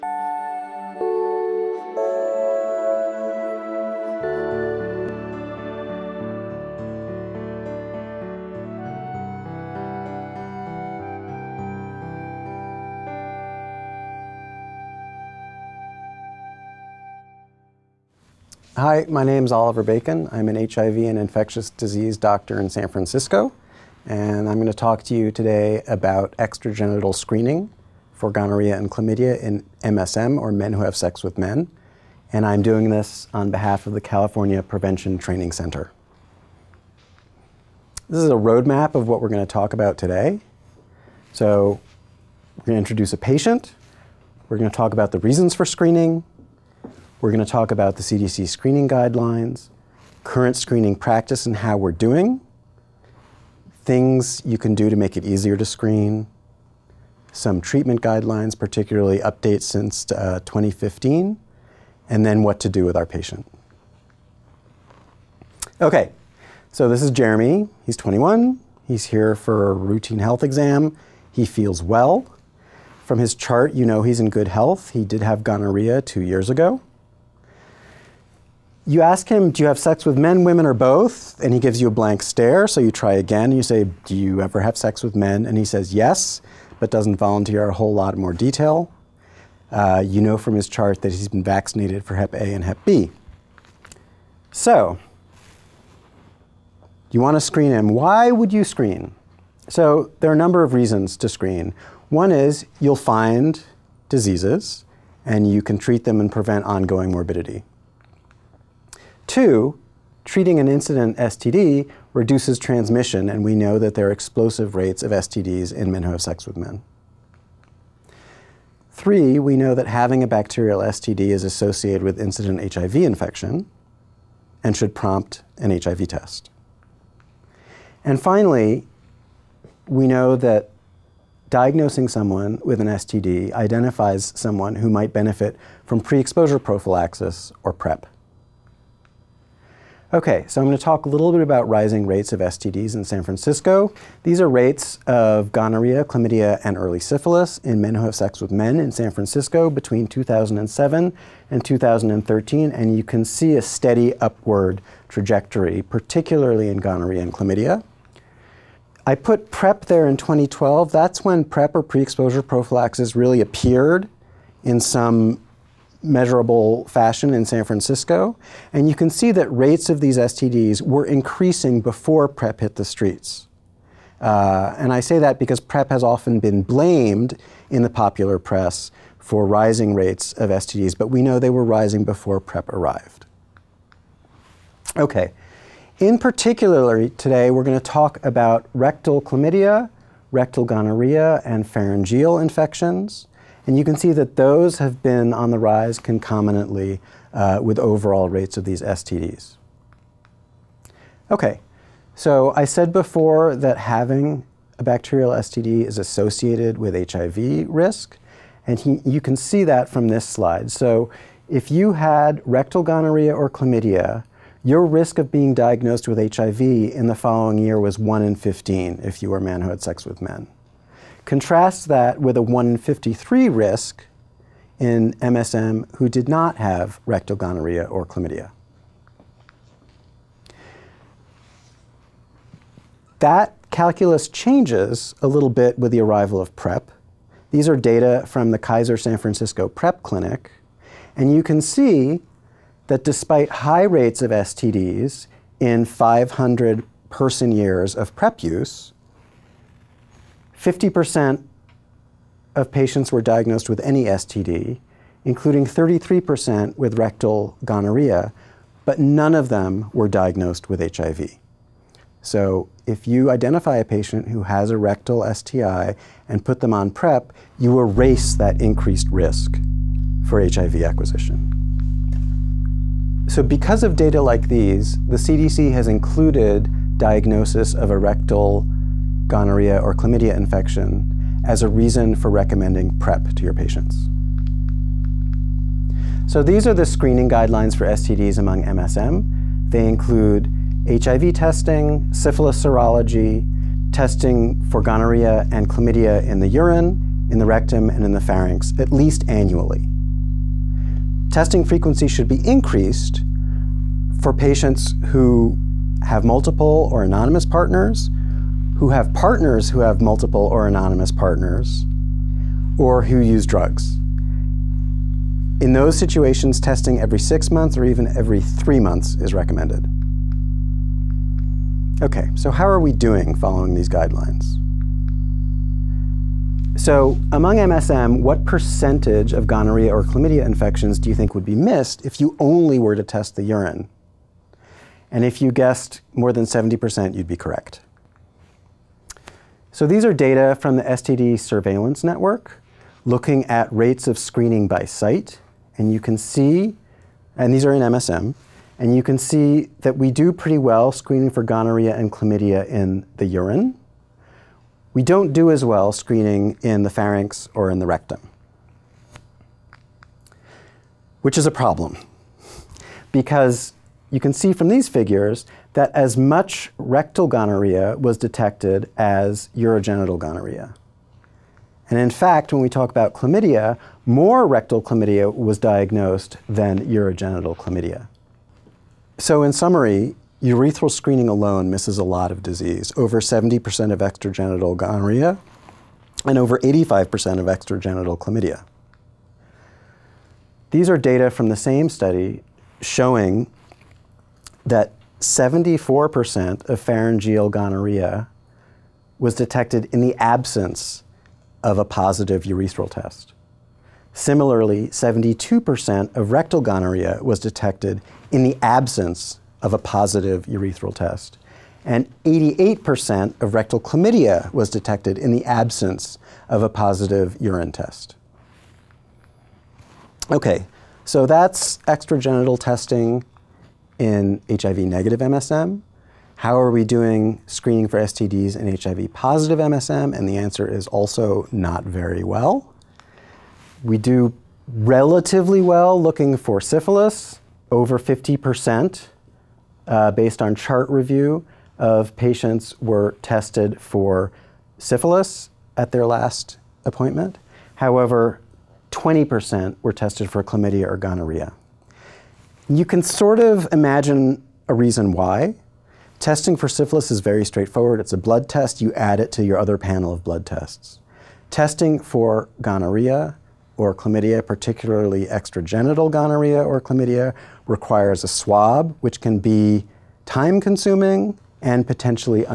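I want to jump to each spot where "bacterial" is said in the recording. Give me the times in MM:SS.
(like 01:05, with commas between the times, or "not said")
02:00, 03:24.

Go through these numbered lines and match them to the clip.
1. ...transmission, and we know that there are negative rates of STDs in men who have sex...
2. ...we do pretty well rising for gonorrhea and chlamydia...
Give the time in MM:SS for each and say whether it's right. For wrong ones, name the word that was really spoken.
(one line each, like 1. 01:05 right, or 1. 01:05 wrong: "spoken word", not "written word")
1. 01:52 wrong: "explosive", not "negative"
2. 05:49 wrong: "screening", not "rising".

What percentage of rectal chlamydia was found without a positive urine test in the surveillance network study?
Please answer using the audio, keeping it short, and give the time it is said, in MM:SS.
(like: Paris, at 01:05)
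88%, at 06:52.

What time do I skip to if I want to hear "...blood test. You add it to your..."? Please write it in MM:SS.
07:38.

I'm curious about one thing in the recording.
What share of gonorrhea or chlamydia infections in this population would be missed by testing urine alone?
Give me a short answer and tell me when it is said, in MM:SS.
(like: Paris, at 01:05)
More than 70%, at 05:36.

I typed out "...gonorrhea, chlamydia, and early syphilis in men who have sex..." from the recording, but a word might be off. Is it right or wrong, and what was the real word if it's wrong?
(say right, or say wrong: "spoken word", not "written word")
right.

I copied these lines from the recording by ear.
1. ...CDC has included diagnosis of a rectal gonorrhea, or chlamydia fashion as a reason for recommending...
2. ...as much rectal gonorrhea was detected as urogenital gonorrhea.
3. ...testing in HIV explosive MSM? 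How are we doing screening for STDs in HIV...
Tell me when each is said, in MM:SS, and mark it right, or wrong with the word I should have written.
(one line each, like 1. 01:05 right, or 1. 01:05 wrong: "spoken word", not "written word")
1. 04:35 wrong: "infection", not "fashion"
2. 06:05 right
3. 07:02 wrong: "negative", not "explosive".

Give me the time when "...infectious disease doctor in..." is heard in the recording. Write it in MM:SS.
00:21.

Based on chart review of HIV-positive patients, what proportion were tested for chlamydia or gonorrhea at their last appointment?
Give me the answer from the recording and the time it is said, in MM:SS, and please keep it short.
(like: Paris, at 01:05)
20%, at 07:28.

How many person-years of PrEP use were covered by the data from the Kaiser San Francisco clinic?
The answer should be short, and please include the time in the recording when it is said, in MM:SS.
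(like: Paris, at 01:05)
500 person years, at 04:05.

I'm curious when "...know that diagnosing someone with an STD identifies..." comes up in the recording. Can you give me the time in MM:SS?
02:10.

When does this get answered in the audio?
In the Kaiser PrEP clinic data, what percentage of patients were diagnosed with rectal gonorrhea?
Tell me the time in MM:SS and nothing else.
04:15.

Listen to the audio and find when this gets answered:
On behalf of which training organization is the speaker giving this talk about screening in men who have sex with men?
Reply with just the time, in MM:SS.
00:33.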